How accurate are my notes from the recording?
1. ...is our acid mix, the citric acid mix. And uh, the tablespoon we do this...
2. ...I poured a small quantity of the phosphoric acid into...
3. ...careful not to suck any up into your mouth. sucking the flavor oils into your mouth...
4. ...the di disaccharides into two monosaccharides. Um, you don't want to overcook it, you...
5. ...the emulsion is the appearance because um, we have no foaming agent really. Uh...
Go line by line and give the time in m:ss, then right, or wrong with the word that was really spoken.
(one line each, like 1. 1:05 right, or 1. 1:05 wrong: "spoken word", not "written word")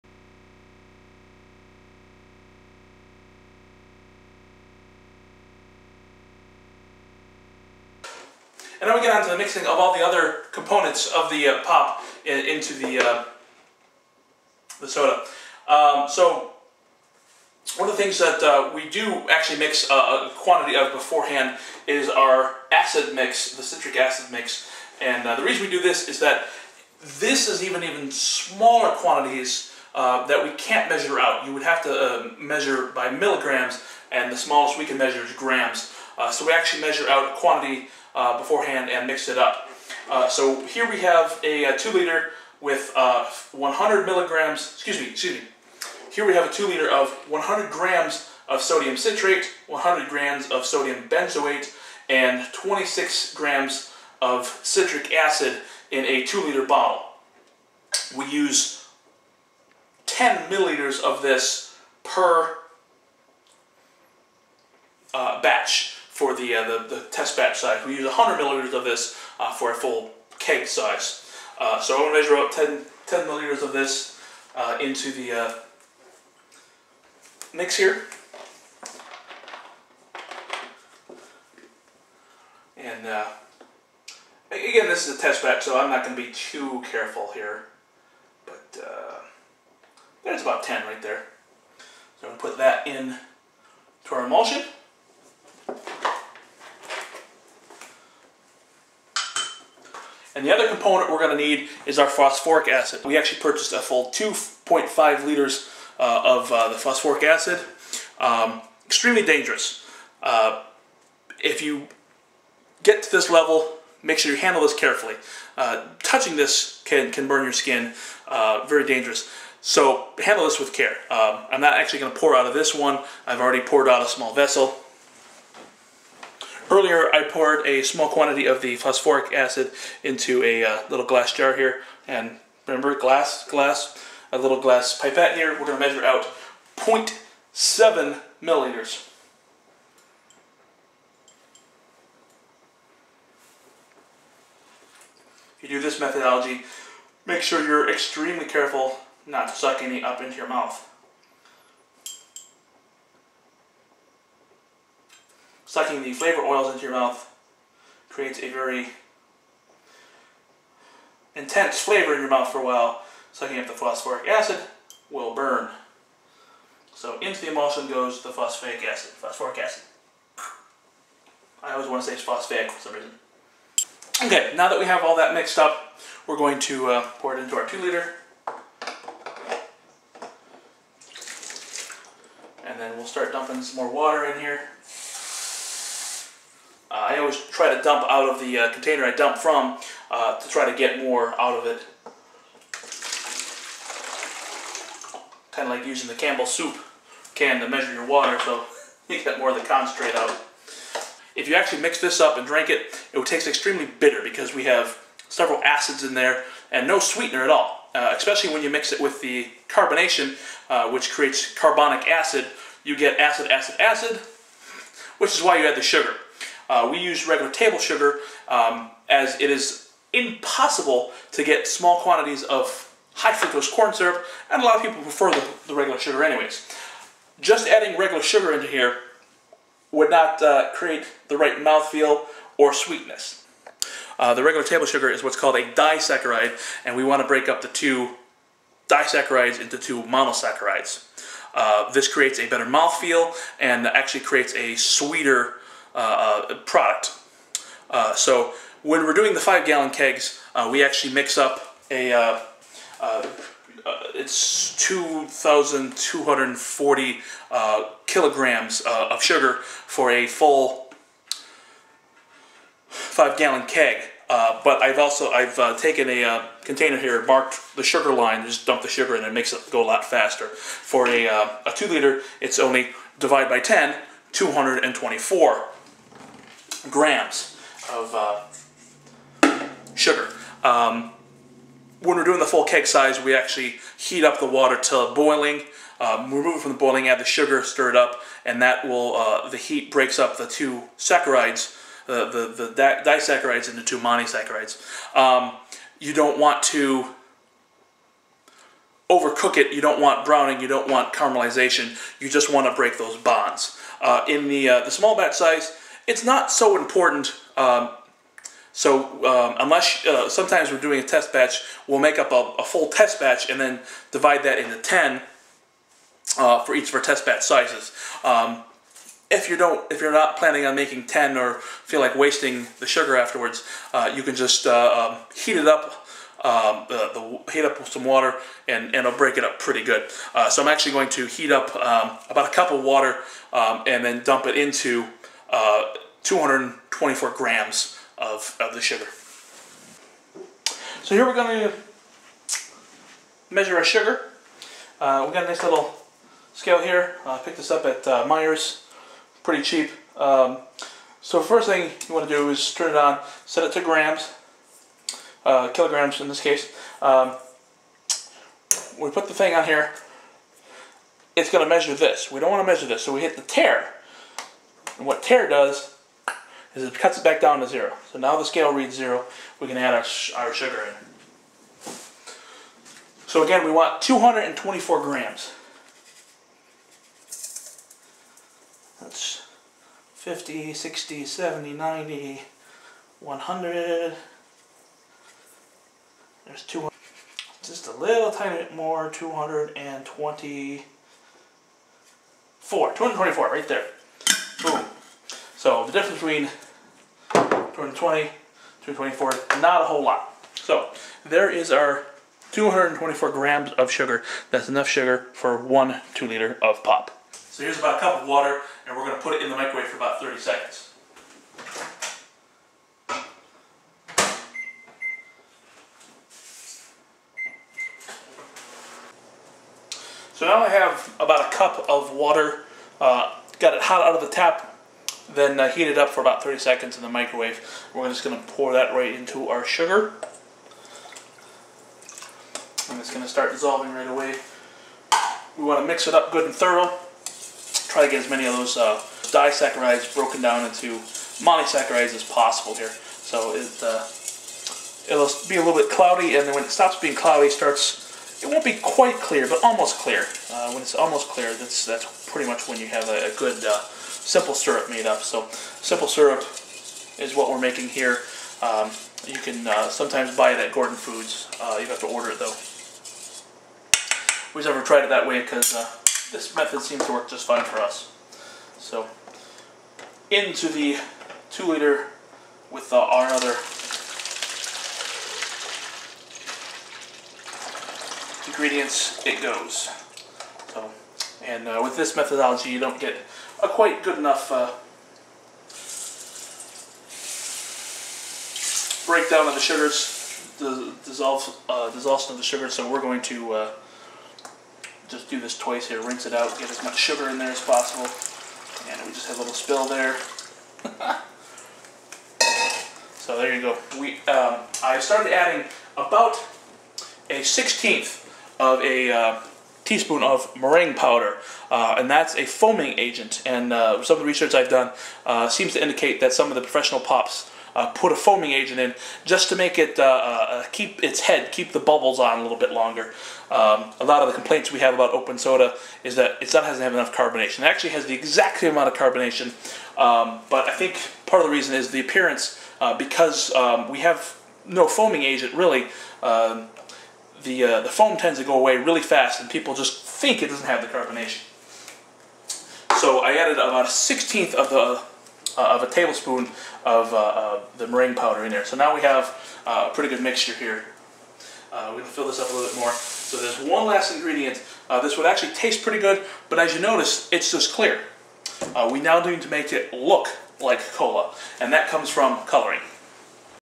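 1. 0:21 wrong: "reason", not "tablespoon"
2. 2:07 right
3. 2:28 right
4. 4:52 right
5. 8:51 wrong: "reason", not "emulsion".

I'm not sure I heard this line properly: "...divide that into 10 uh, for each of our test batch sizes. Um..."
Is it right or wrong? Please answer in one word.
right.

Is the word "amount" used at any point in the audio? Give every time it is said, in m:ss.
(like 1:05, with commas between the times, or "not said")
8:48.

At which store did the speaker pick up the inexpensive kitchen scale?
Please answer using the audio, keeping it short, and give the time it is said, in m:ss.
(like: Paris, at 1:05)
Meijer's, at 5:48.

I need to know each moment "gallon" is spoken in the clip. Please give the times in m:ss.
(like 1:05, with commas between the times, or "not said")
4:09, 4:23.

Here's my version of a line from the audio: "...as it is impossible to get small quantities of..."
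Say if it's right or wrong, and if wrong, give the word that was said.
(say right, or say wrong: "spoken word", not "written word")
right.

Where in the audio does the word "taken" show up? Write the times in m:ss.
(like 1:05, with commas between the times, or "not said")
4:25.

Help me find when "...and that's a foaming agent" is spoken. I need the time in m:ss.
8:31.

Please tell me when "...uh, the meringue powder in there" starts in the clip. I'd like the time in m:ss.
9:07.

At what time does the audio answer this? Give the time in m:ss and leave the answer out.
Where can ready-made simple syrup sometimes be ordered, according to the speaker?
7:40.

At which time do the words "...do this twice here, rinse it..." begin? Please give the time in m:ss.
8:15.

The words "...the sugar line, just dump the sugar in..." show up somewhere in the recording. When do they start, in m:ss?
4:27.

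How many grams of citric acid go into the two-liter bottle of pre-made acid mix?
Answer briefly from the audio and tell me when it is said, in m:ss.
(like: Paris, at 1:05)
26 grams, at 0:52.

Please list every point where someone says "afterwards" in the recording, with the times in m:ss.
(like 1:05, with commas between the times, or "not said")
5:23.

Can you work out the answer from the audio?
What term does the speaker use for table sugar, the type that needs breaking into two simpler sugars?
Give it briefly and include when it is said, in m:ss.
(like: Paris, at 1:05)
disaccharide, at 3:55.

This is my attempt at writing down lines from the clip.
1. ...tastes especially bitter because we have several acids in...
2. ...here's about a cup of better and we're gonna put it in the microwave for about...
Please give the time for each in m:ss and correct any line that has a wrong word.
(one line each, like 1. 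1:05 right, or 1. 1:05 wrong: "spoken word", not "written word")
1. 3:23 wrong: "extremely", not "especially"
2. 6:47 wrong: "water", not "better".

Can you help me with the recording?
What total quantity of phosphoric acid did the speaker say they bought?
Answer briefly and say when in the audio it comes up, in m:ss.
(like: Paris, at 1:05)
2.5 liters, at 1:44.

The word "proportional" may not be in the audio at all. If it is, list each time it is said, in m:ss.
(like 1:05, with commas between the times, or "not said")
not said.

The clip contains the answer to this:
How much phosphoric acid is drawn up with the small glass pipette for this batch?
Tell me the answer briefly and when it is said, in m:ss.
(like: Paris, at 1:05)
0.7 milliliters, at 2:16.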